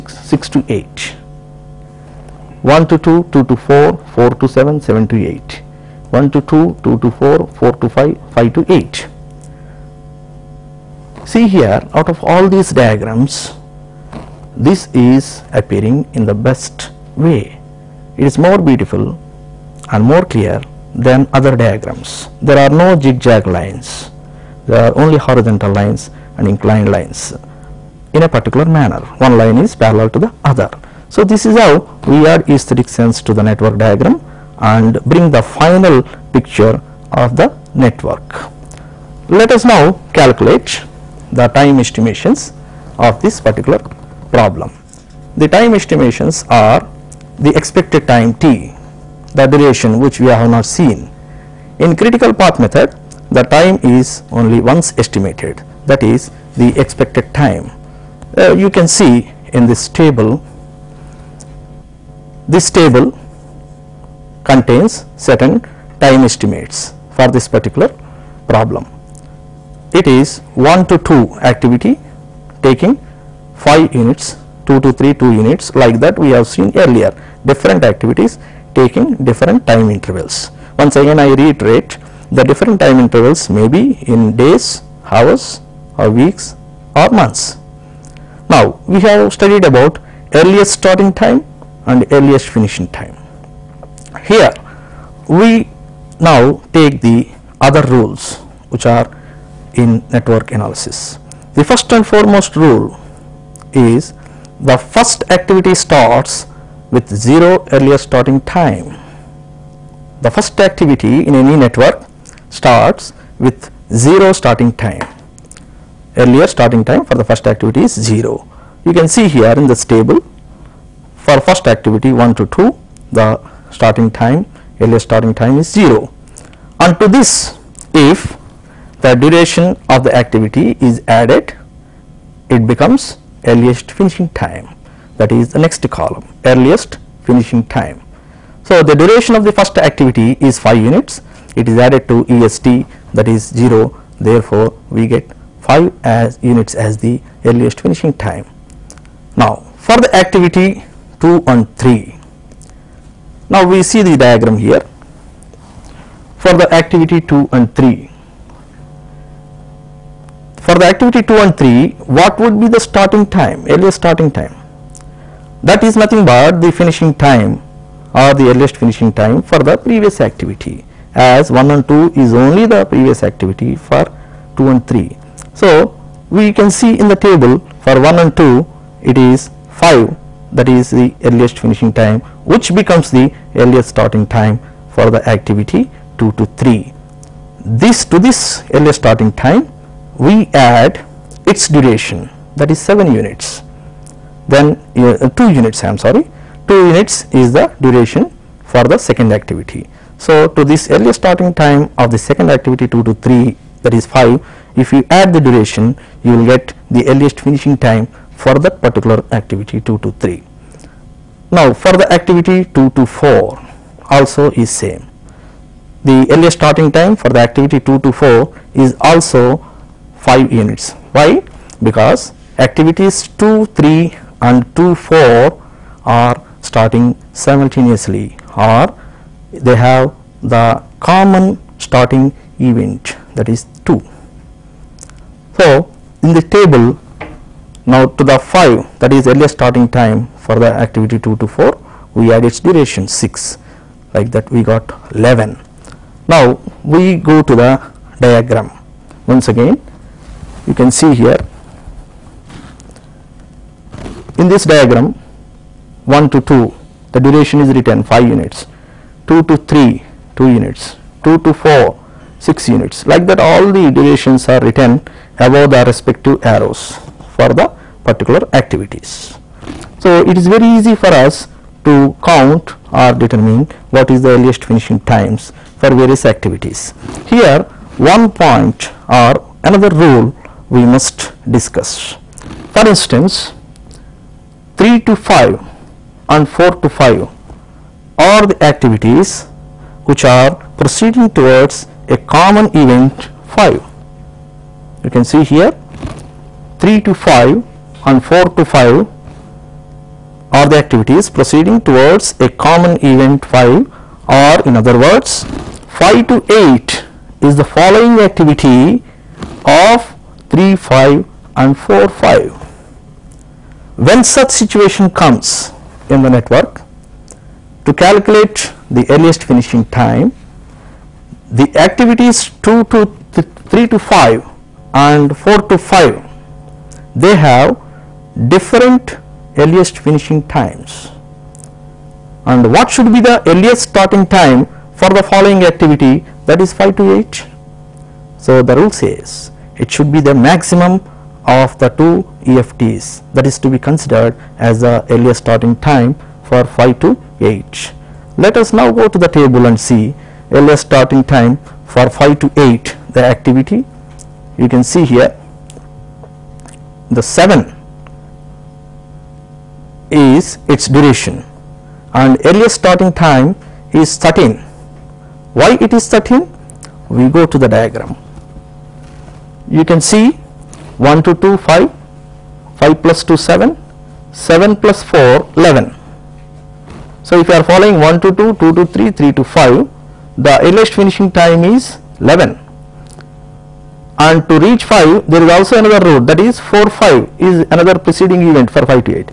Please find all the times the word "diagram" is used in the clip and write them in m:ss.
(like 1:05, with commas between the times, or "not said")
0:12, 0:21, 0:33, 2:34, 4:08, 4:14, 6:07.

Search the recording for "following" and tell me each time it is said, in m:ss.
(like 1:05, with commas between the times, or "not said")
5:07, 5:35, 6:17.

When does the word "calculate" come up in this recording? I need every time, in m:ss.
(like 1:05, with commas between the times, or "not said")
0:40, 5:17.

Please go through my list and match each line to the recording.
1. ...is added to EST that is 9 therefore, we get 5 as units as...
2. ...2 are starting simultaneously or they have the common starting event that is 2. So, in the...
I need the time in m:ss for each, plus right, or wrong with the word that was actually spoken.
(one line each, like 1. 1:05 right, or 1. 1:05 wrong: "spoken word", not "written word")
1. 2:21 wrong: "0", not "9"
2. 3:44 wrong: "4", not "2".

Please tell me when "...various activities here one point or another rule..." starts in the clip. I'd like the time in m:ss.
4:36.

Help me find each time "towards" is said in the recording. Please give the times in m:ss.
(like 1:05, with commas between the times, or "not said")
4:51, 5:01.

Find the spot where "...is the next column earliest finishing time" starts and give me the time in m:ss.
2:15.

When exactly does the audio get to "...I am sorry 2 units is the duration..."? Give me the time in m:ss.
3:15.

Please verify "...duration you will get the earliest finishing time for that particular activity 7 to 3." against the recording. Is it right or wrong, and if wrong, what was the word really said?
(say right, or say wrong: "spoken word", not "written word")
wrong: "2", not "7".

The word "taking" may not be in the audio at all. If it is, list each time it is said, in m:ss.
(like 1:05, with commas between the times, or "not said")
1:12, 1:18.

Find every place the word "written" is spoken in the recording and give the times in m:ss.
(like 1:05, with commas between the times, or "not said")
4:17, 4:24.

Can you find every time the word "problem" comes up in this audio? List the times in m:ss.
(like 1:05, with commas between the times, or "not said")
0:44, 1:08.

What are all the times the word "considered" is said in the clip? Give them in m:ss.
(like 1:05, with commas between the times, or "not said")
5:43.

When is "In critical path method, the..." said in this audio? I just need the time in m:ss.
0:51.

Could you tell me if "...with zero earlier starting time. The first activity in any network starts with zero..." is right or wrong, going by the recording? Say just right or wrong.
right.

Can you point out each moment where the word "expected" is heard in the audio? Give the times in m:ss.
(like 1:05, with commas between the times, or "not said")
0:47, 0:56.